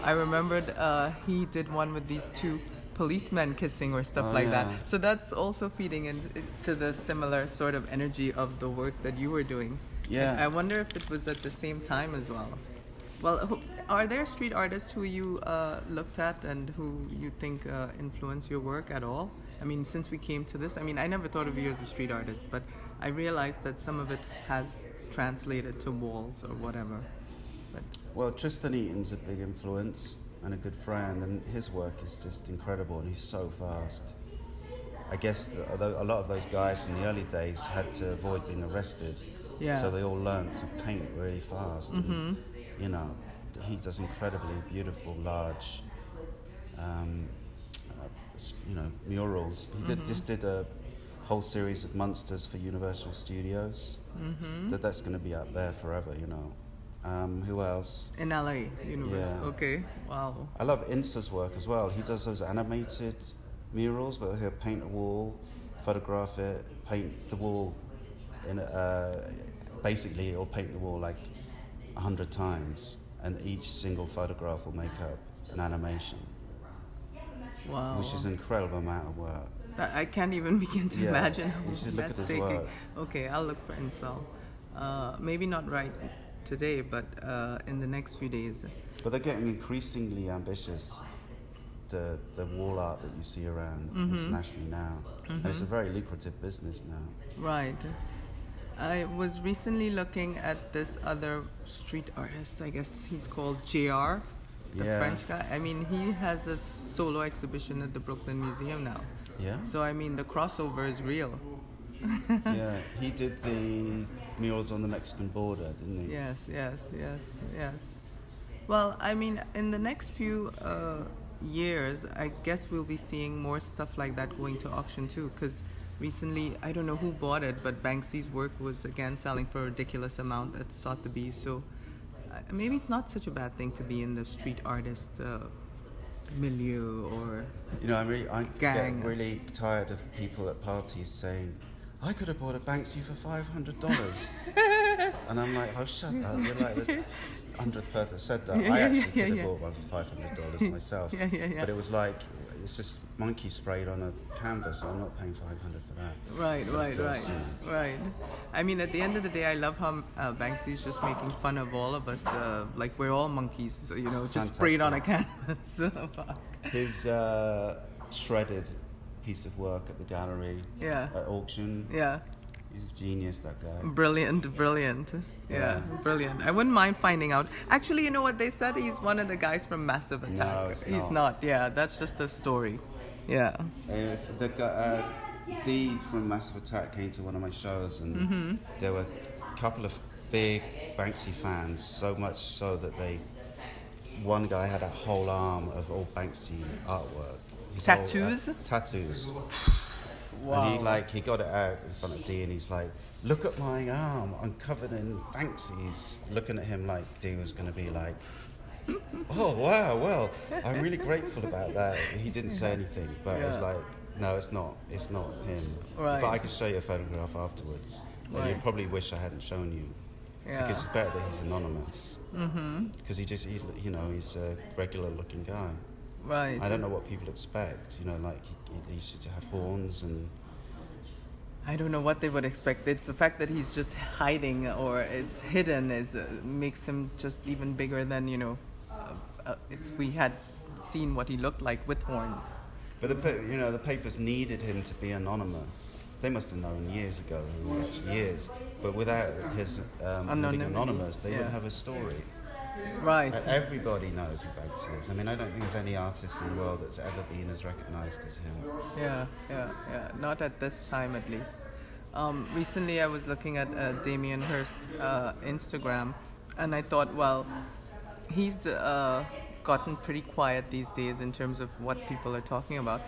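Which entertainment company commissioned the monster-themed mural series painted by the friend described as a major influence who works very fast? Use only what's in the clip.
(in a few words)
Universal Studios.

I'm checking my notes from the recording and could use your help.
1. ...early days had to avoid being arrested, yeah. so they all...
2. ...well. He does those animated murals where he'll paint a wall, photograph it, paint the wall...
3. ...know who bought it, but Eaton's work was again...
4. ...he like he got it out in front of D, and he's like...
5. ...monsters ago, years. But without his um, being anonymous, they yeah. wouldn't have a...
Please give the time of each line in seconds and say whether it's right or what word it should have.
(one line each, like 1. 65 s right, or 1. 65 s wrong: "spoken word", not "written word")
1. 37 s right
2. 61 s right
3. 126 s wrong: "Banksy", not "Eaton"
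4. 200 s right
5. 246 s wrong: "years", not "monsters".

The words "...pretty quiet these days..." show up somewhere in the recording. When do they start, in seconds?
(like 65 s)
269 s.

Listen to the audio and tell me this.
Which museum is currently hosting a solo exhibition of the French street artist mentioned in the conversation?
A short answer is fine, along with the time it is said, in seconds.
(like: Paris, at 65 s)
Brooklyn Museum, at 107 s.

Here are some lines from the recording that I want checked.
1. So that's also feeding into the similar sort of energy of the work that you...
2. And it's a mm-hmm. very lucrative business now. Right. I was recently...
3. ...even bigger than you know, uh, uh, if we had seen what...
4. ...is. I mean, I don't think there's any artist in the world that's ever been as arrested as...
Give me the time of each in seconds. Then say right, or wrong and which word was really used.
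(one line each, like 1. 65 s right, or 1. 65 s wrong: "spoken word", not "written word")
1. 4 s right
2. 95 s right
3. 237 s right
4. 254 s wrong: "recognised", not "arrested".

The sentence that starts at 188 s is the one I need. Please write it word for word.
there were a couple of big Banksy fans.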